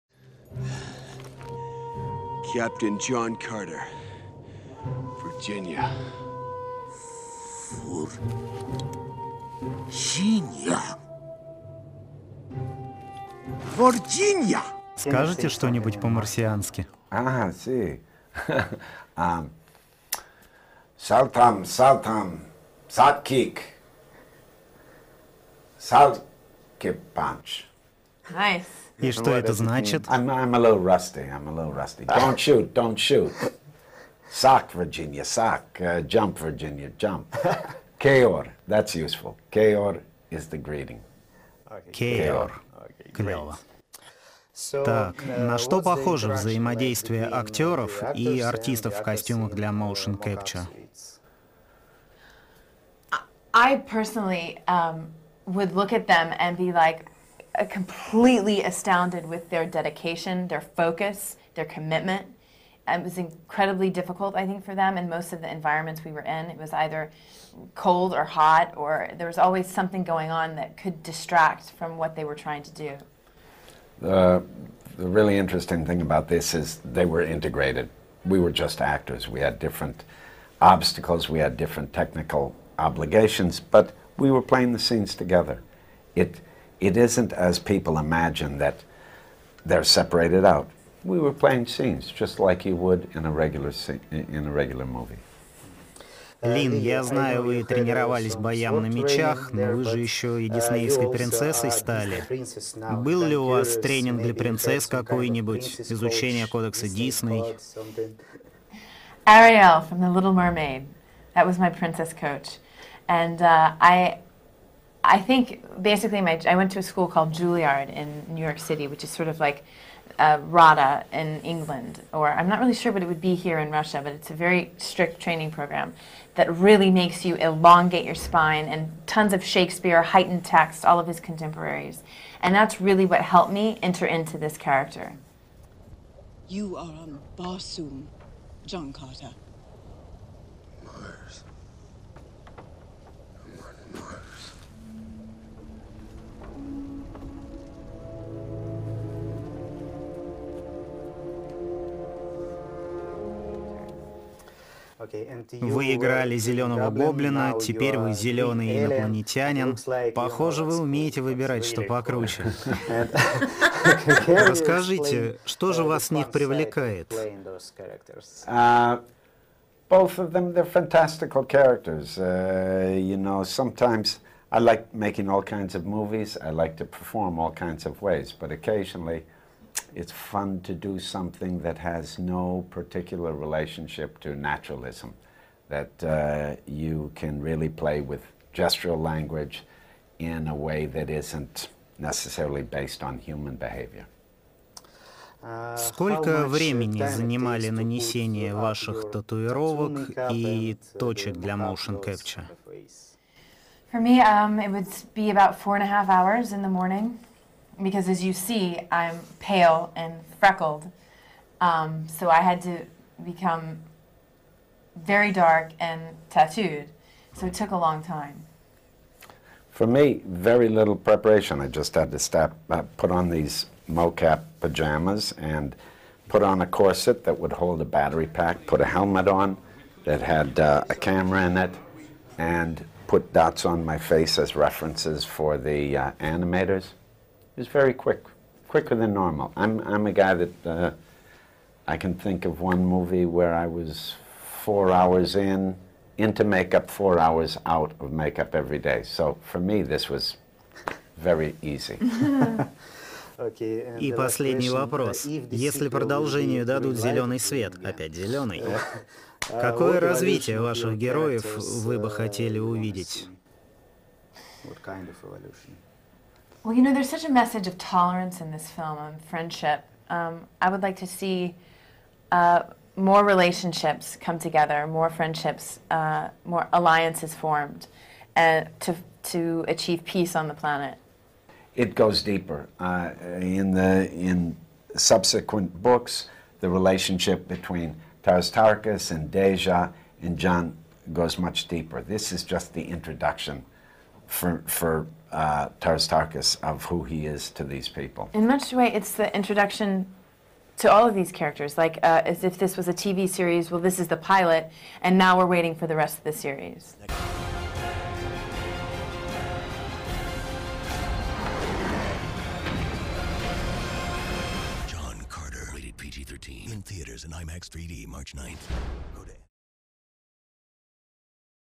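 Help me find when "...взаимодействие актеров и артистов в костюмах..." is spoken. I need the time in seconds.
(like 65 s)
46 s.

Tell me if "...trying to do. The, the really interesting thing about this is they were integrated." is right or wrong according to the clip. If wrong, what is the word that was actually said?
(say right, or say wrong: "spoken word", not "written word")
right.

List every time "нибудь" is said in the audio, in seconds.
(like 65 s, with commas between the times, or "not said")
15 s, 104 s.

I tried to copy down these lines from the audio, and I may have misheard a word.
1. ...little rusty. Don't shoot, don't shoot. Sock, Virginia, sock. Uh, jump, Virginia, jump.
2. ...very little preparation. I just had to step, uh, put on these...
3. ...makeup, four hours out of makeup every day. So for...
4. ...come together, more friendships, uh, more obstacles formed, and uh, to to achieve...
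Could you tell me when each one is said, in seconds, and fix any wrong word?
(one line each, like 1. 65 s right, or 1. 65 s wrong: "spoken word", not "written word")
1. 31 s right
2. 220 s right
3. 246 s right
4. 274 s wrong: "alliances", not "obstacles".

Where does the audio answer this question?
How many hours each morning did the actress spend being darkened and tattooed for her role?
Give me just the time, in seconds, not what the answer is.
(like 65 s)
205 s.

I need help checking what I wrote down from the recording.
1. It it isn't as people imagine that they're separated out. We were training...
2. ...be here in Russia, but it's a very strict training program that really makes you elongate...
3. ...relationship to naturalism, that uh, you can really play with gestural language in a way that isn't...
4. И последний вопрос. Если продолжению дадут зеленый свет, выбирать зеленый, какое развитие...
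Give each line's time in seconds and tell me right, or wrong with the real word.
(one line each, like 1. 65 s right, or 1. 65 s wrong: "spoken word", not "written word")
1. 86 s wrong: "playing", not "training"
2. 123 s right
3. 183 s right
4. 253 s wrong: "опять", not "выбирать".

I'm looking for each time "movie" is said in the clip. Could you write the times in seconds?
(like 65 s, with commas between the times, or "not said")
94 s, 175 s, 242 s.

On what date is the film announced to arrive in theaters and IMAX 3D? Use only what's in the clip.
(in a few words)
March 9th.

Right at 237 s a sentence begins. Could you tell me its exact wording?
was very quick, quicker than normal.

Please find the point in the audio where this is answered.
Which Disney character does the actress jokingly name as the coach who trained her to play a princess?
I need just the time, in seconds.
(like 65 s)
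109 s.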